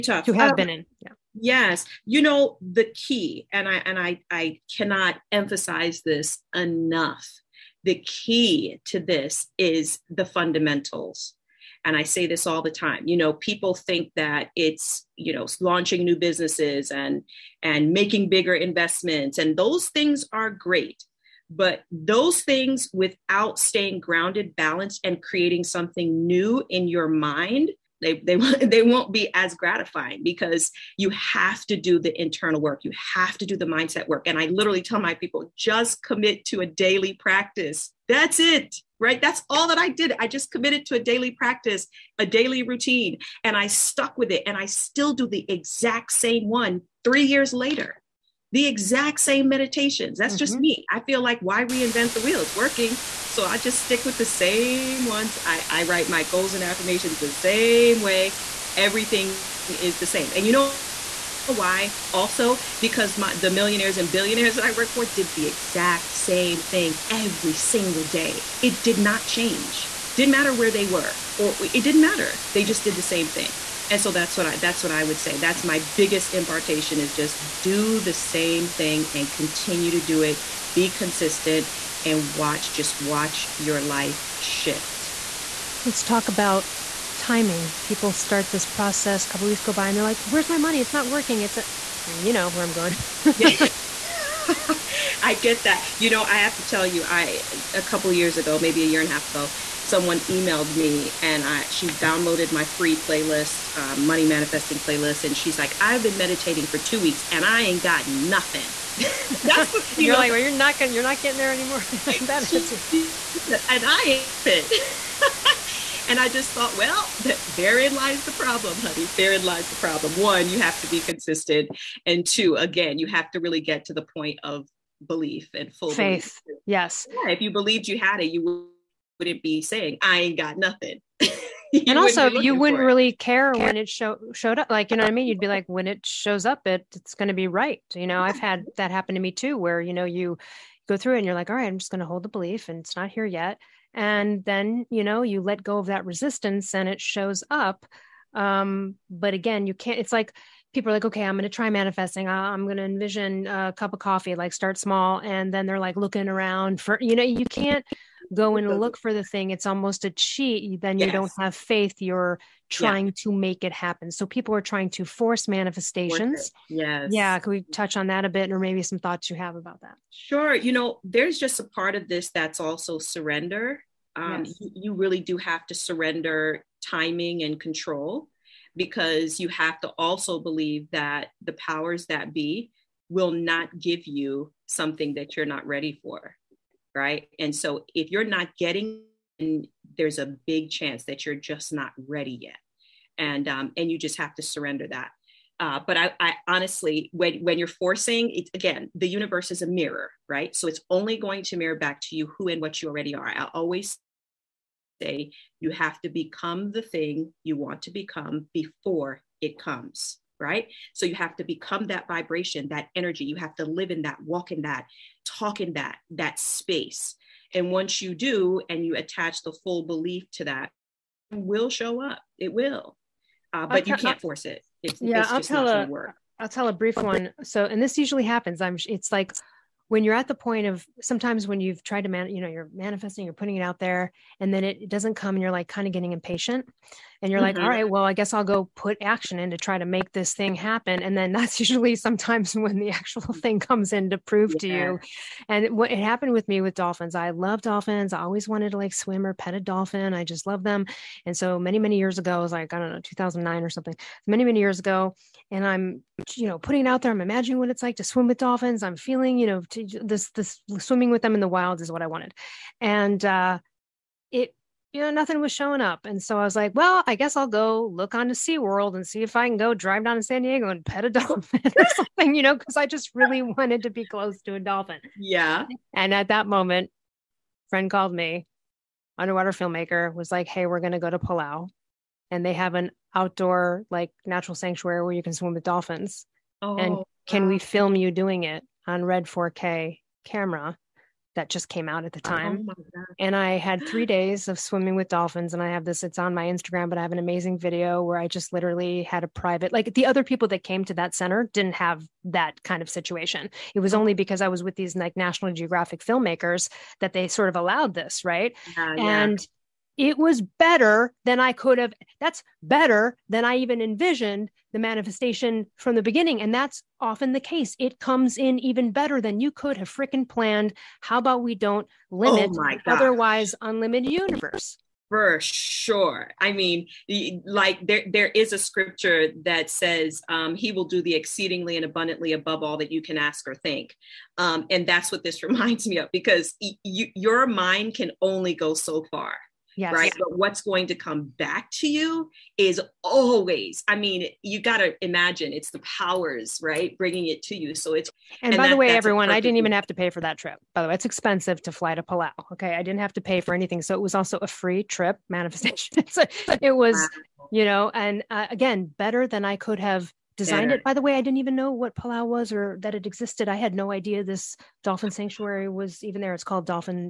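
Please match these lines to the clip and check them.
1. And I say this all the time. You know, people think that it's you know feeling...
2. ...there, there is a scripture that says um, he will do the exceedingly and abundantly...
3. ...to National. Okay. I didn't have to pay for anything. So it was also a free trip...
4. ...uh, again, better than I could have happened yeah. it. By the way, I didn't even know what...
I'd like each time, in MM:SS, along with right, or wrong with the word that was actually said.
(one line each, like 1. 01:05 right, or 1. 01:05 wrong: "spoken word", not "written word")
1. 00:11 wrong: "launching", not "feeling"
2. 05:27 right
3. 05:51 wrong: "Palau", not "National"
4. 05:58 wrong: "designed", not "happened".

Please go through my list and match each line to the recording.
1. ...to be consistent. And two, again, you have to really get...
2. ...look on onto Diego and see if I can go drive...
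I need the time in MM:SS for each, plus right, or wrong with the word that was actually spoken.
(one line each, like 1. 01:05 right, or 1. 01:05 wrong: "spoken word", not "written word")
1. 02:00 right
2. 04:27 wrong: "SeaWorld", not "Diego".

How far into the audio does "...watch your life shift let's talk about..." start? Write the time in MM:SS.
01:22.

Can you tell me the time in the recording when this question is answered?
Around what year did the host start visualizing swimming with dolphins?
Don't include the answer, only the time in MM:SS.
04:13.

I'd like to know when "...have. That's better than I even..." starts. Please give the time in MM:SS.
05:11.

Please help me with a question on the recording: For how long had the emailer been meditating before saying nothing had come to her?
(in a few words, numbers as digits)
2 weeks.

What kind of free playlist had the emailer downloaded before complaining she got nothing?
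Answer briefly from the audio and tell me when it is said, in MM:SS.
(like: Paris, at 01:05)
Money manifesting playlist, at 01:44.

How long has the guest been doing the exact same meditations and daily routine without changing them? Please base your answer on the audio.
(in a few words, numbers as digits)
3 years.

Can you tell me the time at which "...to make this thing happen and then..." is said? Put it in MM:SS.
03:59.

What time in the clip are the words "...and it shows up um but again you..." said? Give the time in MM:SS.
02:26.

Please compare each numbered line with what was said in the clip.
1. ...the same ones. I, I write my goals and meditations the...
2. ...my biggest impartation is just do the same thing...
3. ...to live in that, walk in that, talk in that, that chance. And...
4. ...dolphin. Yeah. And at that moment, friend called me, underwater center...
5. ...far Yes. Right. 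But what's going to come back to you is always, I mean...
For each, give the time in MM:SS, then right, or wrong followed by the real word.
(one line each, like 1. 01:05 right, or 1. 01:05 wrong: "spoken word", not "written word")
1. 00:54 wrong: "affirmations", not "meditations"
2. 01:15 right
3. 03:33 wrong: "space", not "chance"
4. 04:34 wrong: "filmmaker", not "center"
5. 05:39 right.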